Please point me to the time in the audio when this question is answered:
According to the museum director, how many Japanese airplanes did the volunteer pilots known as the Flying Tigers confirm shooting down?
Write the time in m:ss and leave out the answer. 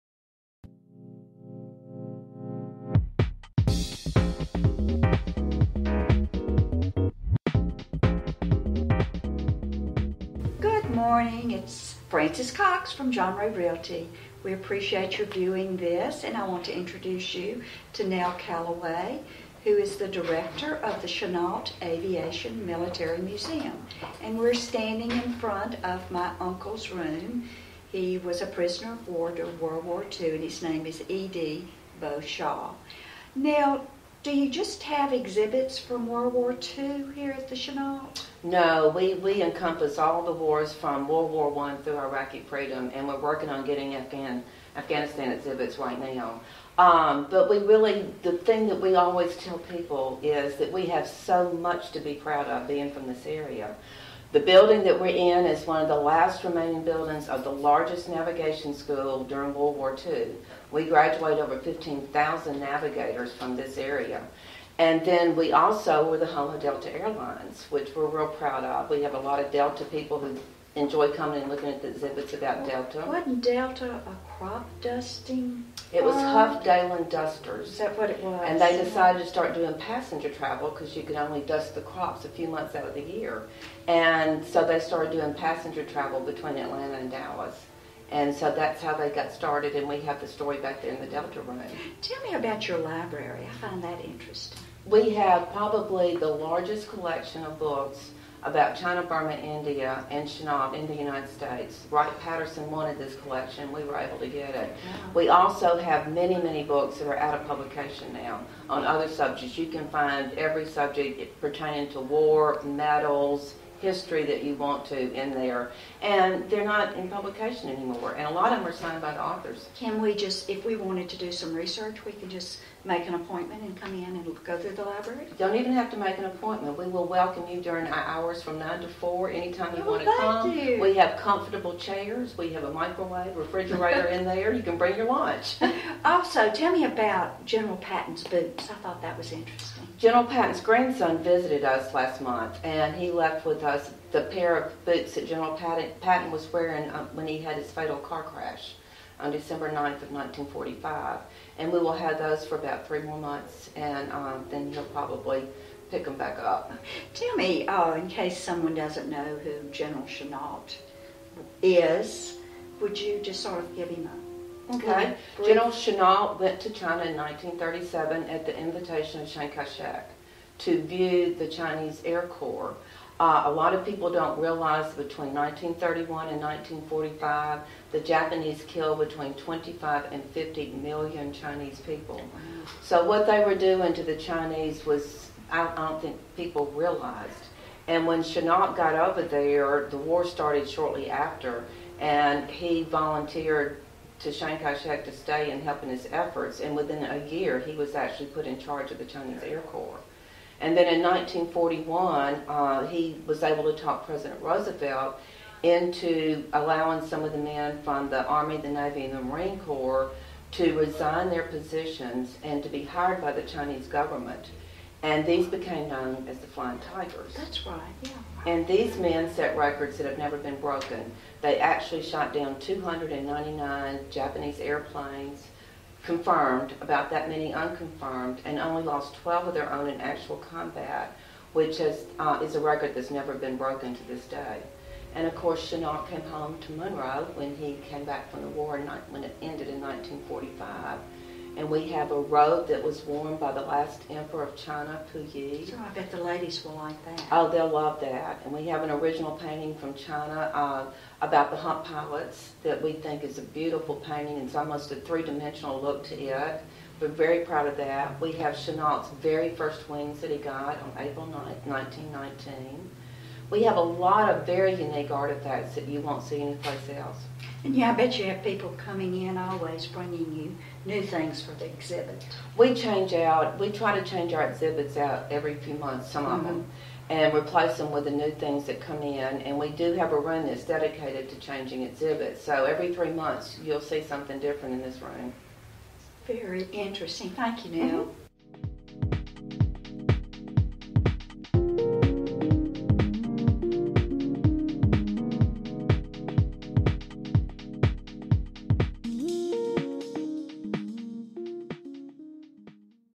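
3:42.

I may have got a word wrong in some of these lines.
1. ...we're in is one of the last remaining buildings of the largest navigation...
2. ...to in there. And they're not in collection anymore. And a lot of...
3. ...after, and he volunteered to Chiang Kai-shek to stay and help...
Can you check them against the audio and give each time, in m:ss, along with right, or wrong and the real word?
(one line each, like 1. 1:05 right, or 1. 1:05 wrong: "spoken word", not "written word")
1. 0:54 right
2. 1:54 wrong: "publication", not "collection"
3. 3:11 right.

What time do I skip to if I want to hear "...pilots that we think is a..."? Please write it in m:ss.
4:11.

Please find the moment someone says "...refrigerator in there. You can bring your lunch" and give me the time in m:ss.
2:13.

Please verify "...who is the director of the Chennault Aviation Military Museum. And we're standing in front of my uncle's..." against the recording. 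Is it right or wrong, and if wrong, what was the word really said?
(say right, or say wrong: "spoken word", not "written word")
right.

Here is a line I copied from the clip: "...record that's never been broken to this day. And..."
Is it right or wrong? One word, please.
right.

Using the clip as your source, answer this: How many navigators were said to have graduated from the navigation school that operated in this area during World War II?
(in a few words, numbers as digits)
over 15,000.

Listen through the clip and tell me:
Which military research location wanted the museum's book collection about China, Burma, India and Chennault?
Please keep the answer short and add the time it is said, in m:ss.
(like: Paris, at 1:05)
Wright-Patterson, at 1:41.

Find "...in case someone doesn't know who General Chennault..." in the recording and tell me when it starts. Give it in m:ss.
2:37.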